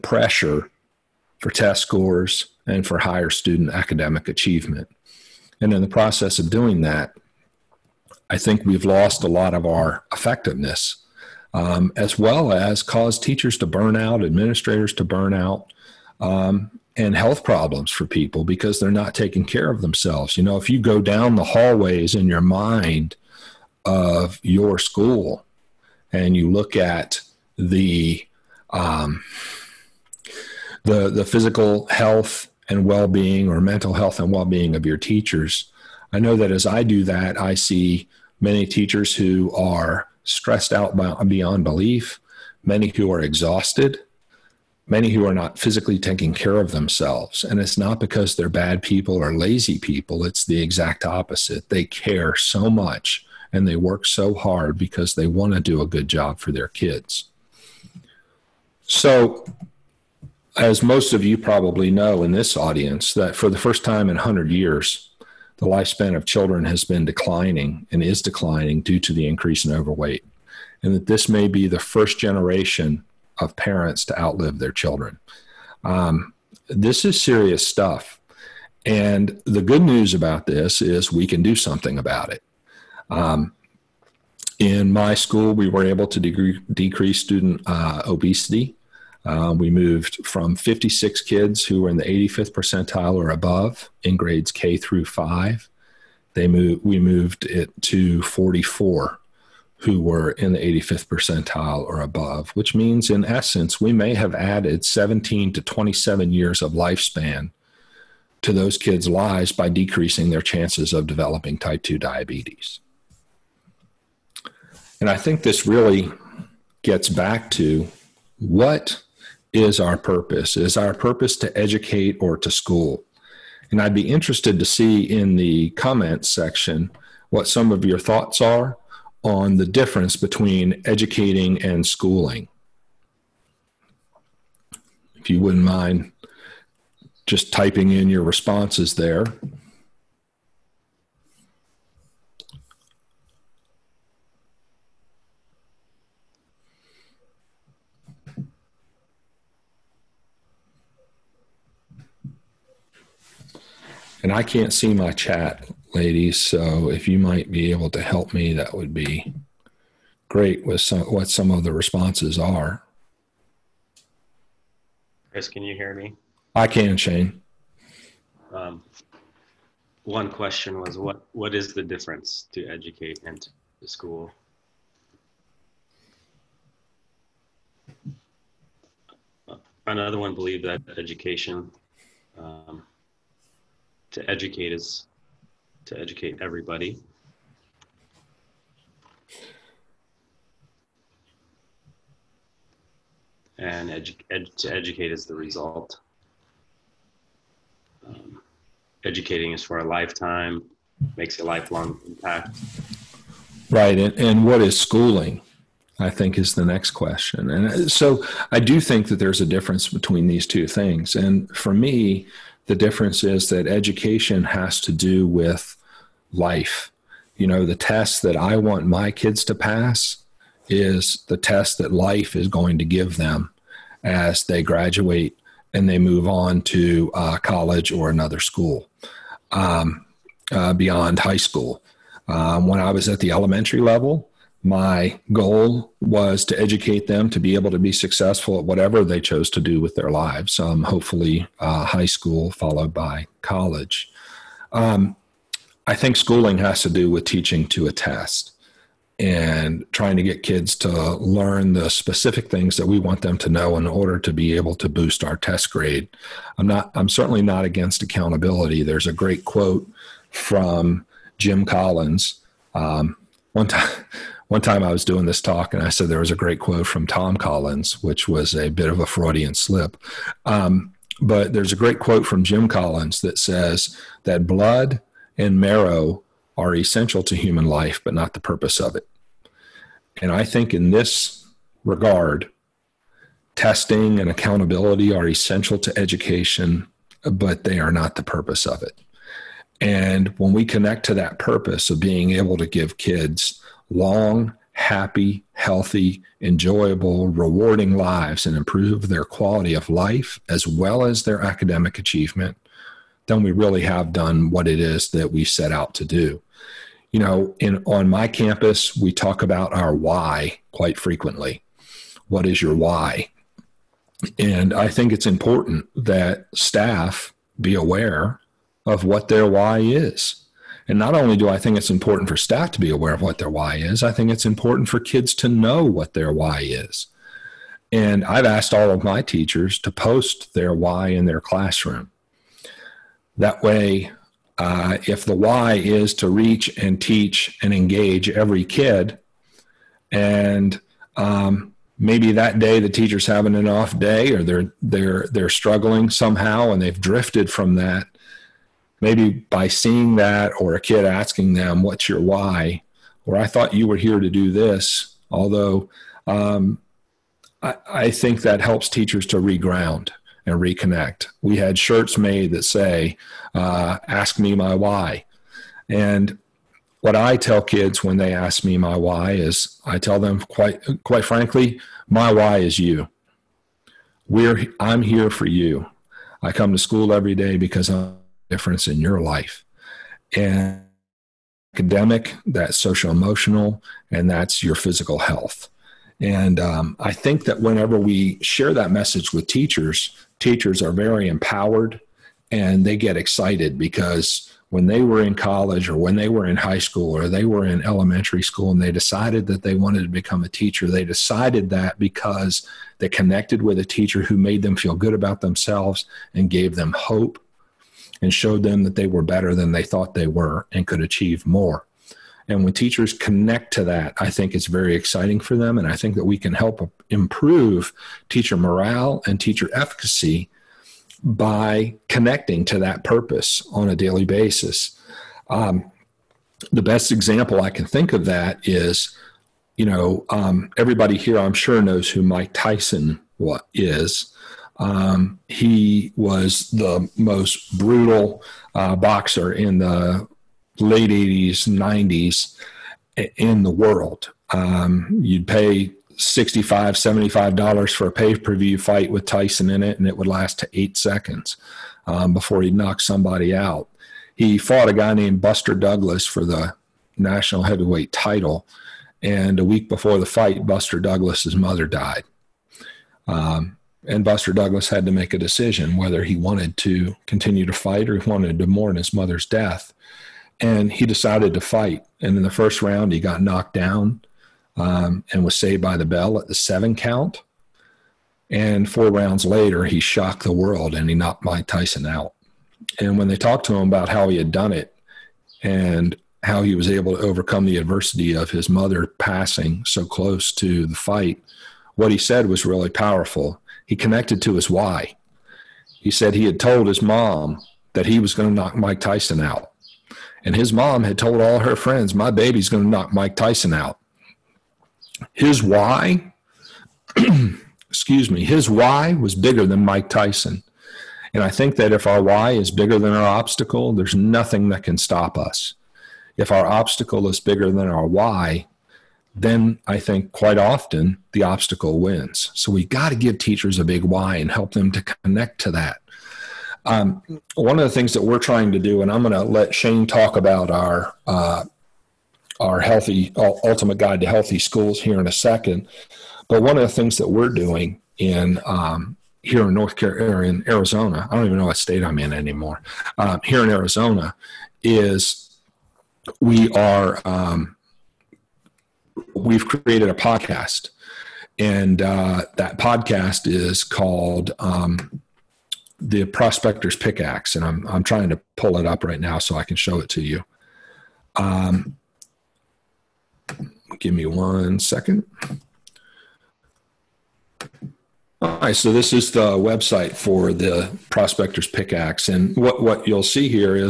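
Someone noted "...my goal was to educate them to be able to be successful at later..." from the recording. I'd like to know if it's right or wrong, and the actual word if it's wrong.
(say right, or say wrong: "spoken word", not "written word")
wrong: "whatever", not "later".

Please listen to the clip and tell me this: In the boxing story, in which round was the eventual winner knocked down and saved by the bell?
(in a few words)
first round.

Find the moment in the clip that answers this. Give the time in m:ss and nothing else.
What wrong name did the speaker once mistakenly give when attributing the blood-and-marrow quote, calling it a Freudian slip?
4:27.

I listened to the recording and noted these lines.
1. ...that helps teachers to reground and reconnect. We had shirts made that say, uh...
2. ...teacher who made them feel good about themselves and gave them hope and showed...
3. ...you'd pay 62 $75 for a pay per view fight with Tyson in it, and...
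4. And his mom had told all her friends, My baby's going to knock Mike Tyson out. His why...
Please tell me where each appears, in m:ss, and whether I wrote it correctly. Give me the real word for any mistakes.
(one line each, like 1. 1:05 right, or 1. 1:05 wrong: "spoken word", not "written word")
1. 5:58 right
2. 6:43 right
3. 7:25 wrong: "65", not "62"
4. 8:20 right.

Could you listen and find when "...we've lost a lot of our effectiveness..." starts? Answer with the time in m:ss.
0:08.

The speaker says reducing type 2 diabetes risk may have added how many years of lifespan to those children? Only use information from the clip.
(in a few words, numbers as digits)
17 to 27.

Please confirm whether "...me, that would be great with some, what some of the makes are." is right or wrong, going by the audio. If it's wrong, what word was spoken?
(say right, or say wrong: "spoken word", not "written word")
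wrong: "responses", not "makes".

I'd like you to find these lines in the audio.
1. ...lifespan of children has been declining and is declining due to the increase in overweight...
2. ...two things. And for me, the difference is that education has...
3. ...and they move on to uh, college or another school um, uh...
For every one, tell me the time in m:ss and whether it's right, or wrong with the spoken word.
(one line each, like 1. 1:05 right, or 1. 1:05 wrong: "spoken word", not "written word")
1. 1:05 right
2. 3:30 right
3. 3:45 right.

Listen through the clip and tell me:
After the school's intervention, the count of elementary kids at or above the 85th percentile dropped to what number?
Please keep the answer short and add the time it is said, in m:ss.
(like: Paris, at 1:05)
44, at 1:38.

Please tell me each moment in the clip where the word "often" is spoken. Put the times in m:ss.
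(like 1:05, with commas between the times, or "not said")
8:40.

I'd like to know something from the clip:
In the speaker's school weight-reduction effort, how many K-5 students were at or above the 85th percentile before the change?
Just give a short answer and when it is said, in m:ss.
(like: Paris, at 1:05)
56, at 1:30.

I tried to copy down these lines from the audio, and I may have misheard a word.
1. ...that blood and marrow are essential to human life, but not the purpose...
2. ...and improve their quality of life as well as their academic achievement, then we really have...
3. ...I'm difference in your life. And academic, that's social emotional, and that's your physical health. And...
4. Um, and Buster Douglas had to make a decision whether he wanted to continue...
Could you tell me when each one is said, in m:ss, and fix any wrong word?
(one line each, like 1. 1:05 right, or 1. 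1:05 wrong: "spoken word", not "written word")
1. 4:34 right
2. 4:58 right
3. 6:17 right
4. 7:43 right.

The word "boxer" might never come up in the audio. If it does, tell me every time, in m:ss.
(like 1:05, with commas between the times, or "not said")
7:18.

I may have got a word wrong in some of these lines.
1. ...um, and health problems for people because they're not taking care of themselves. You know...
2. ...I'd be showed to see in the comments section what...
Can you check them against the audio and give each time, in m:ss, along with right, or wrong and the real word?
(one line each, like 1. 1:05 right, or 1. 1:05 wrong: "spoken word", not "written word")
1. 0:16 right
2. 2:03 wrong: "interested", not "showed".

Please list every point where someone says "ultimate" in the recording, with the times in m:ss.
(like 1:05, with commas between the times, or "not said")
8:53.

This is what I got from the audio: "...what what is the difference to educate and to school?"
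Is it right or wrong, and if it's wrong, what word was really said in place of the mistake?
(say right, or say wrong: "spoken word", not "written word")
right.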